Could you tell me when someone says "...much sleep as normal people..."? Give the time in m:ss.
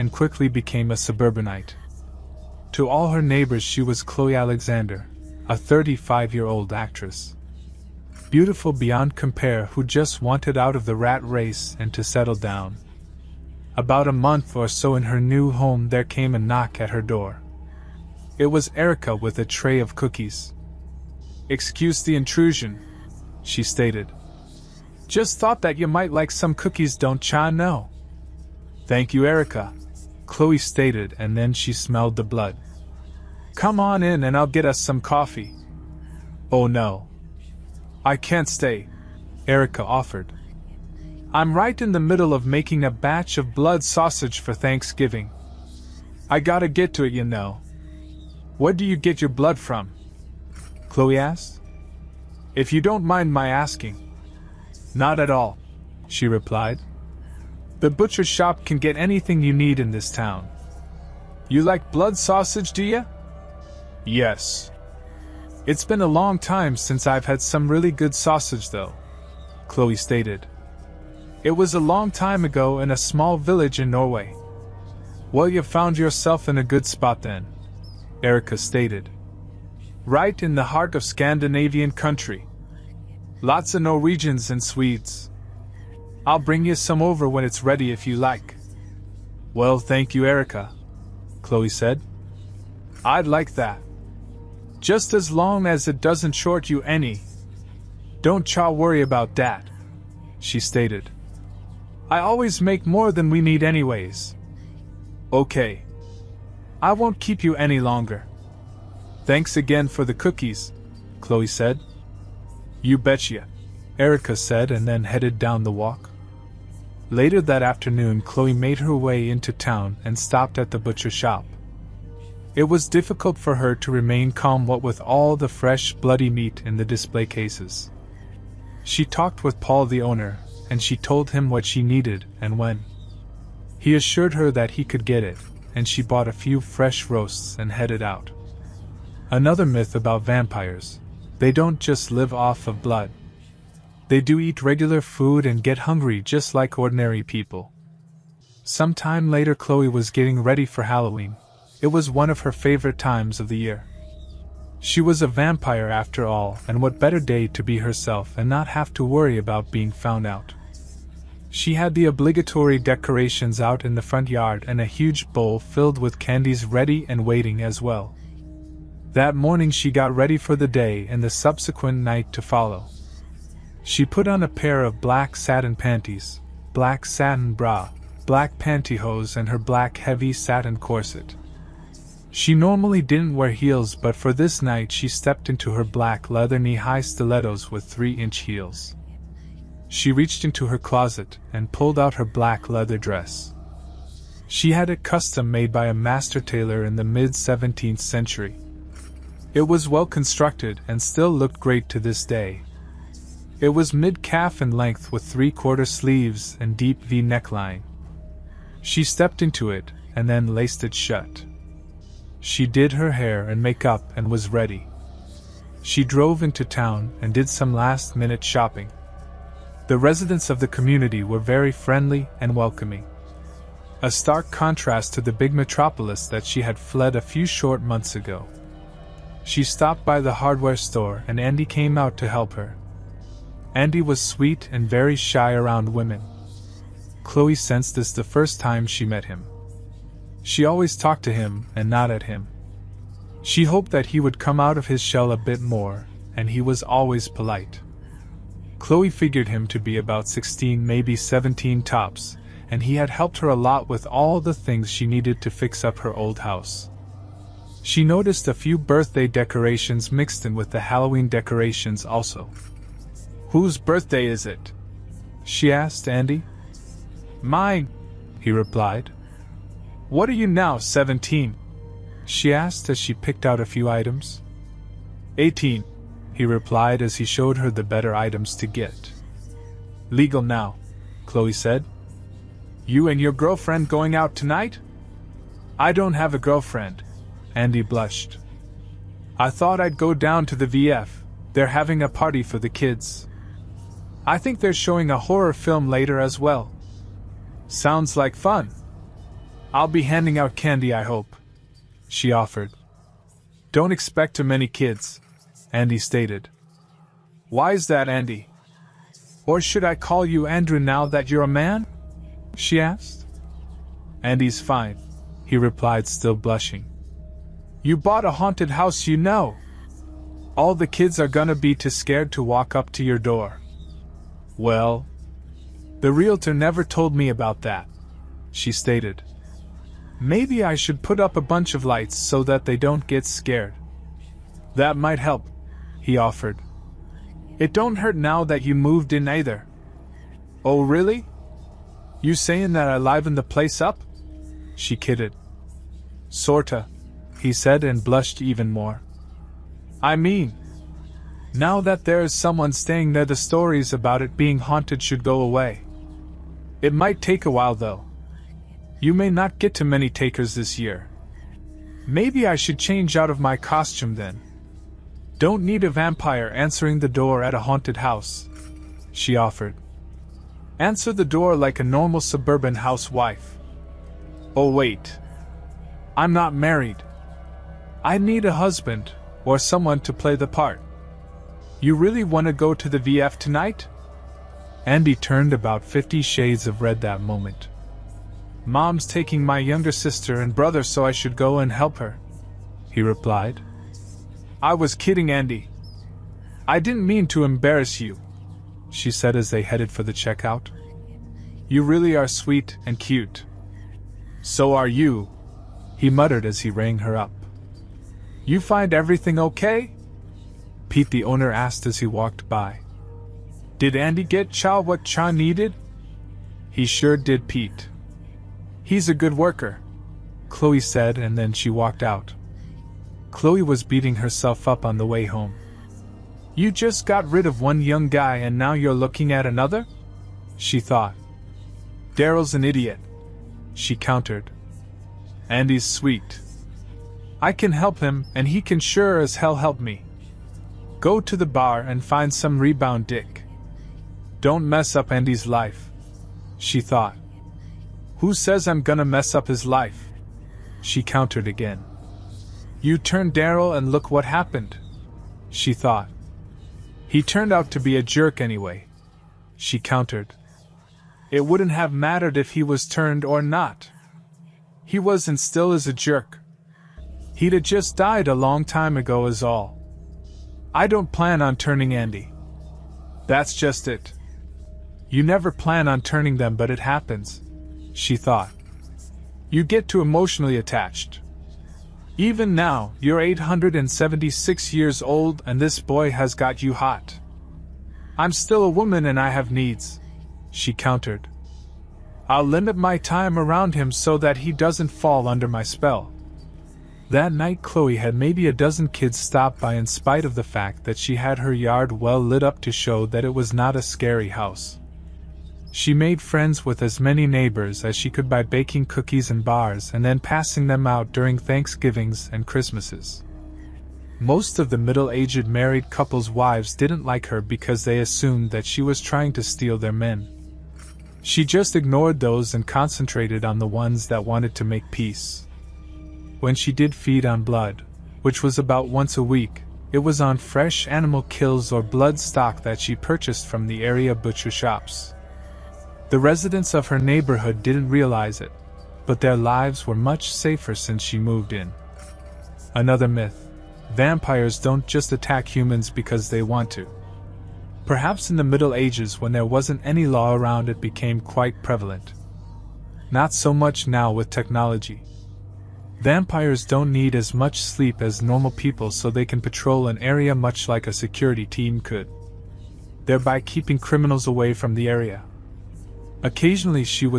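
9:17.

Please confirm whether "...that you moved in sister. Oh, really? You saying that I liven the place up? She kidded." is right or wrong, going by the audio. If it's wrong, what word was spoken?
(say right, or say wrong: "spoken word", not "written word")
wrong: "either", not "sister".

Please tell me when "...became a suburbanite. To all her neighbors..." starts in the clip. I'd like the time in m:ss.
0:00.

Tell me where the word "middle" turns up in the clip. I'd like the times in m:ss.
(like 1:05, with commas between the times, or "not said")
0:41, 8:34, 9:08.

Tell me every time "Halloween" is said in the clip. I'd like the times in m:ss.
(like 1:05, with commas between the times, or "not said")
2:30, 4:20.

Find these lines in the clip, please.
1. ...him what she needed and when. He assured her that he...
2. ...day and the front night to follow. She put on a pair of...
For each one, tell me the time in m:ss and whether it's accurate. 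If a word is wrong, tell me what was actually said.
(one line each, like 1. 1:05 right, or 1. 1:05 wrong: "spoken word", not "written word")
1. 2:11 right
2. 2:50 wrong: "subsequent", not "front".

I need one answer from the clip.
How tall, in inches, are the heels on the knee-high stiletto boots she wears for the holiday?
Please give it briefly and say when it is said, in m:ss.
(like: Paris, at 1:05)
3 inches, at 3:07.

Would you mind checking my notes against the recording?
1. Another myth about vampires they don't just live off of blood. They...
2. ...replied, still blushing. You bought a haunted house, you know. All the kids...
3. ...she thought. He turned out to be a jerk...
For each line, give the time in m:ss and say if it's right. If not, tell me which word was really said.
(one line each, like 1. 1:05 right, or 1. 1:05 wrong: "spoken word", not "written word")
1. 2:19 right
2. 5:15 right
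3. 7:35 right.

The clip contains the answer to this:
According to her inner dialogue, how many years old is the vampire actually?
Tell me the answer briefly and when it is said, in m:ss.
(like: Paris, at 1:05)
876, at 8:03.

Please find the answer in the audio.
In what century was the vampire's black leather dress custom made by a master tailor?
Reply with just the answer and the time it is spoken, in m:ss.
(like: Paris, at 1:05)
17th century, at 3:17.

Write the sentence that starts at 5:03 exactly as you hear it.
Don't expect too many kids, Andy stated.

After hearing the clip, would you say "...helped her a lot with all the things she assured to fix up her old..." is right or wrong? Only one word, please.
wrong.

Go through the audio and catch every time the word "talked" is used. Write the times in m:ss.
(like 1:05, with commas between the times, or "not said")
2:09, 4:00.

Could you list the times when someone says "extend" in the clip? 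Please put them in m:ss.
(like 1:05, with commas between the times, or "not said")
not said.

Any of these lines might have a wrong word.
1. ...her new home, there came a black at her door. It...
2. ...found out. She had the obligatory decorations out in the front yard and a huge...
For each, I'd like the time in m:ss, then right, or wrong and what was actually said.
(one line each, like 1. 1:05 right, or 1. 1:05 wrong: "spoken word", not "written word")
1. 0:15 wrong: "knock", not "black"
2. 2:39 right.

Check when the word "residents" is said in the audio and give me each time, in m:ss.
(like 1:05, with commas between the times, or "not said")
3:39, 8:56.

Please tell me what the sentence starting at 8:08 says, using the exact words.
I'm still a woman and I have needs, she countered.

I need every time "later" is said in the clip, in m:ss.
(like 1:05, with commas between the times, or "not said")
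1:57, 2:29, 4:55.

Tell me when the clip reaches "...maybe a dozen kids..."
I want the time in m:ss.
8:18.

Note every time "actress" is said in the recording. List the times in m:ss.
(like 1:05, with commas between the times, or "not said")
0:06.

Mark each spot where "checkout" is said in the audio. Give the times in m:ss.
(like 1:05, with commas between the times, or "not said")
6:40.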